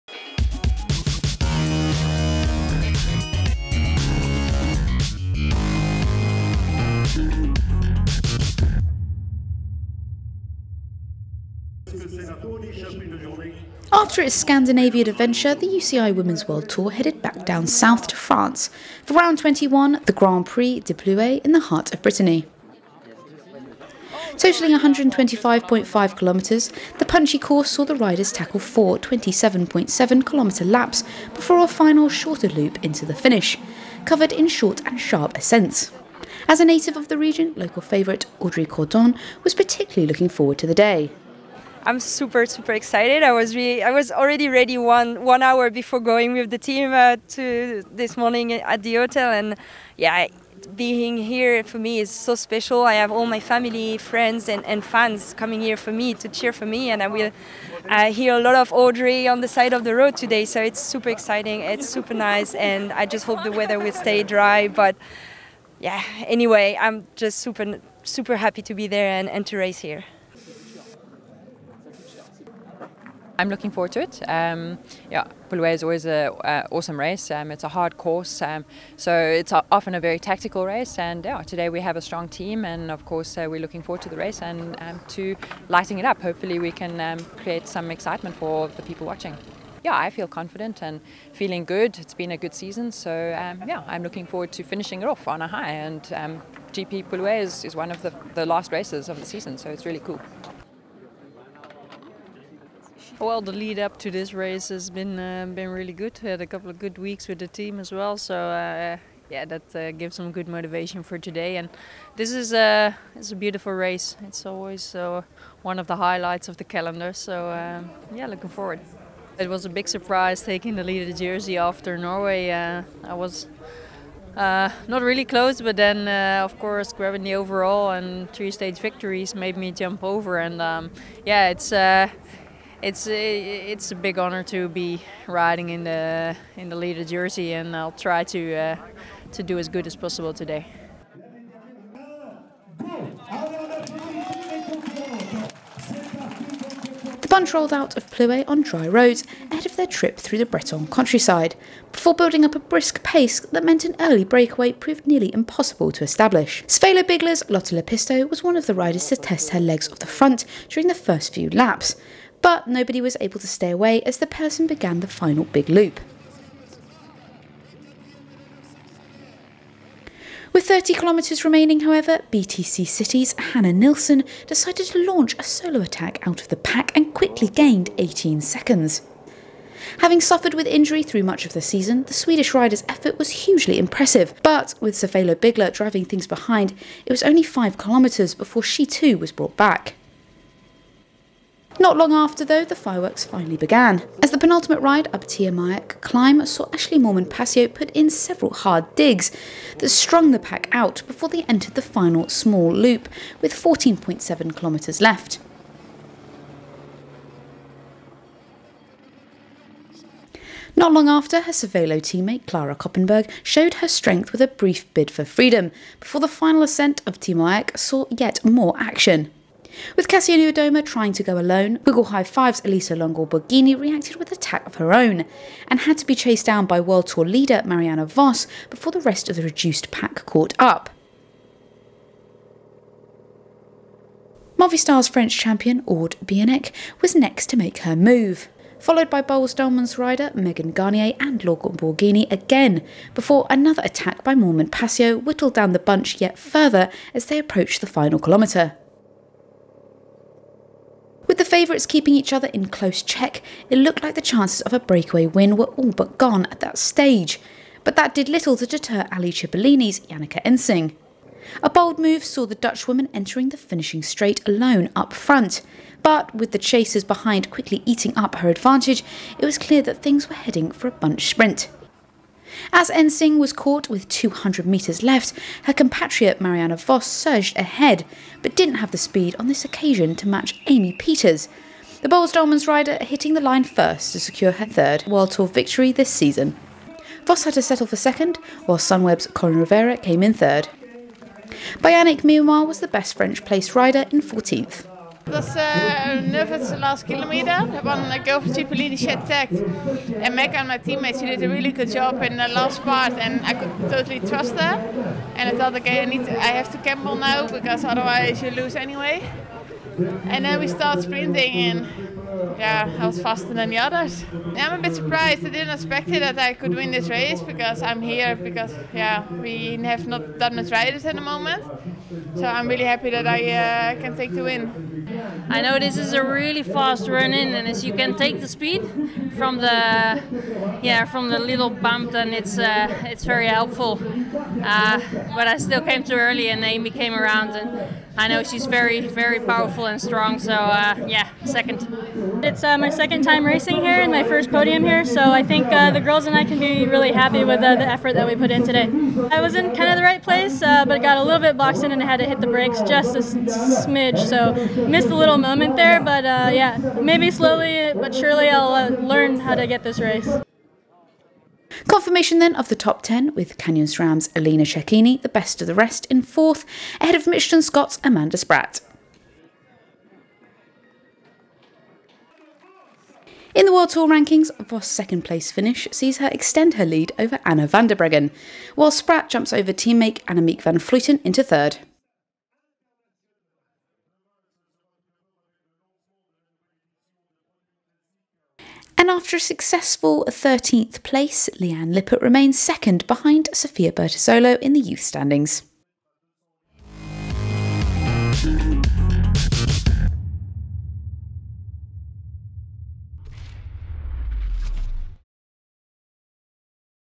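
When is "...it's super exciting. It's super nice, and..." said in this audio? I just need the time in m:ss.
1:00.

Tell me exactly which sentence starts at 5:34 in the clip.
Uh, but I still came too early, and Amy came around, and I know she's very very powerful and strong.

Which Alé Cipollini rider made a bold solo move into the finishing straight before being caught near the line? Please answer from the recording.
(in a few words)
Janneke Ensing.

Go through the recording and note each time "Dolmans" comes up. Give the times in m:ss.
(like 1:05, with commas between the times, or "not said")
3:59, 4:42.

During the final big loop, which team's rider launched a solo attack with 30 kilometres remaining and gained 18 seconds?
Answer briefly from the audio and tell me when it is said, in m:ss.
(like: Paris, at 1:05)
BTC City, at 2:52.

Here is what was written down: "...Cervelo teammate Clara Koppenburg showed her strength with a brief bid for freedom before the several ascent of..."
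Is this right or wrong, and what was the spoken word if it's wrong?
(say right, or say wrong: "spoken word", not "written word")
wrong: "final", not "several".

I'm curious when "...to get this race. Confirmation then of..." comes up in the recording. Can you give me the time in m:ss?
5:59.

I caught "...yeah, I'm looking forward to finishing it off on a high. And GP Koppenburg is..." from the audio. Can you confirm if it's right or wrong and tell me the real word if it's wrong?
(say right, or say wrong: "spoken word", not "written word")
wrong: "Plouay", not "Koppenburg".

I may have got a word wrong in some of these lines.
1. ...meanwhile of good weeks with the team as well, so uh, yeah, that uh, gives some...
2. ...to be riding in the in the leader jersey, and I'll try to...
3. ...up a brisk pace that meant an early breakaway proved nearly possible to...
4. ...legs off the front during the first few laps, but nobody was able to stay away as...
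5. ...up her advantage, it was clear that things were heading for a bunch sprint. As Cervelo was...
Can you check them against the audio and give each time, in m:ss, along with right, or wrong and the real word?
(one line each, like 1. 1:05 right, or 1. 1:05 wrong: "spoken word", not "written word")
1. 1:46 wrong: "couple", not "meanwhile"
2. 2:14 right
3. 2:32 wrong: "impossible", not "possible"
4. 2:39 right
5. 4:28 wrong: "Ensing", not "Cervelo".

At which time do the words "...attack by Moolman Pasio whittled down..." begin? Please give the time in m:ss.
4:03.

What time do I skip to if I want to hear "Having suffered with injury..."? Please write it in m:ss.
2:59.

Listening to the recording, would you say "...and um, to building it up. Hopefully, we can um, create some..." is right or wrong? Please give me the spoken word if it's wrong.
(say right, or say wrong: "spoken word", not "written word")
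wrong: "lighting", not "building".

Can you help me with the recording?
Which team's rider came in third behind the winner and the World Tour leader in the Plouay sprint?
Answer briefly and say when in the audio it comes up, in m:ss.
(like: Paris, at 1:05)
Sunweb, at 4:48.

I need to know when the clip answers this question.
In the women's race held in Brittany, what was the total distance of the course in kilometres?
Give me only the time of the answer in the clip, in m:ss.
0:24.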